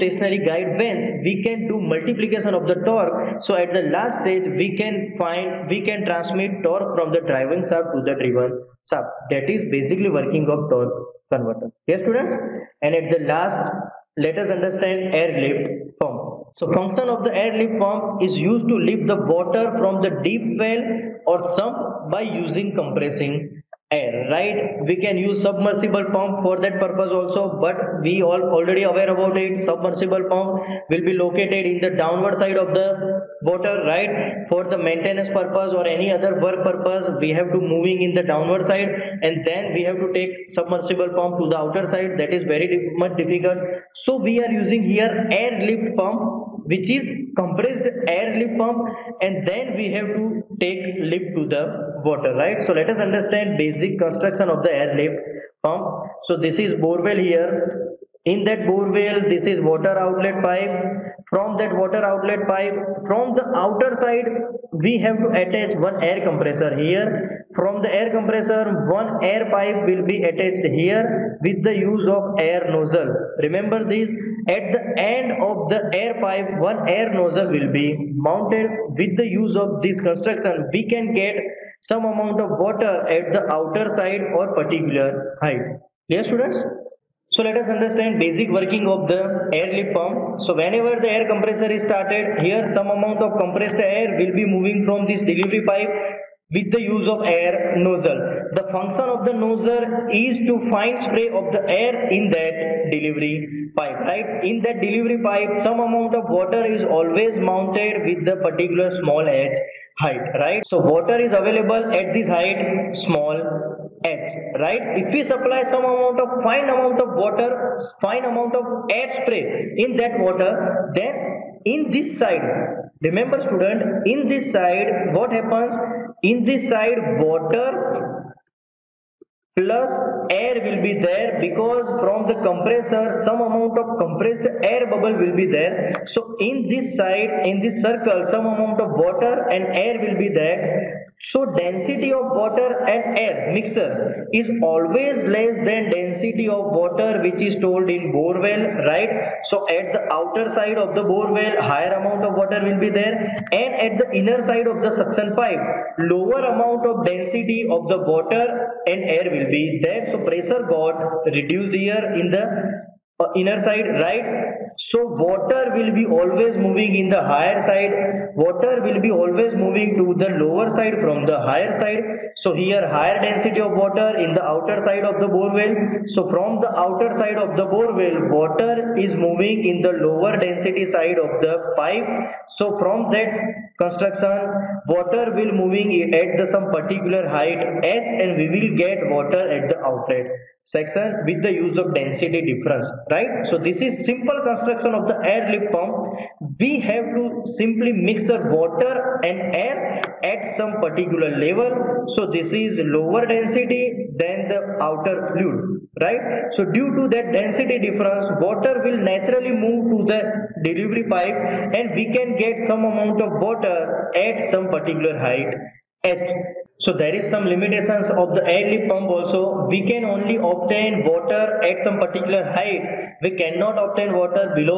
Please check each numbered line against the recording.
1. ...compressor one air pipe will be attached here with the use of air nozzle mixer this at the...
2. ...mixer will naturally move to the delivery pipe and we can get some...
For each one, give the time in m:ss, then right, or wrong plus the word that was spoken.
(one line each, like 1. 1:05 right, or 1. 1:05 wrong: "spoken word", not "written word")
1. 1:08 wrong: "remember", not "mixer"
2. 3:28 wrong: "water", not "mixer".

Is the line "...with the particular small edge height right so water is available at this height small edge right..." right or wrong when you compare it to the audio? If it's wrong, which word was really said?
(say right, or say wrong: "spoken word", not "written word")
right.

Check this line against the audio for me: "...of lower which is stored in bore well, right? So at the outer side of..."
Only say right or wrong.
wrong.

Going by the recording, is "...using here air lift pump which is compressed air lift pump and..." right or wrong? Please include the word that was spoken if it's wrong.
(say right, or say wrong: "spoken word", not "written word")
right.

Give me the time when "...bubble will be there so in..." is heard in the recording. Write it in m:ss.
2:14.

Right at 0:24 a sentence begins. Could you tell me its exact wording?
We can use submersible pump for that purpose also, but we all already aware about it.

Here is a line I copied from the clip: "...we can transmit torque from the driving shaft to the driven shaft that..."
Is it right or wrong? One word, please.
right.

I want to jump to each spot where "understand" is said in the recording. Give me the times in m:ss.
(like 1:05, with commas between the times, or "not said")
0:14, 0:53, 1:27.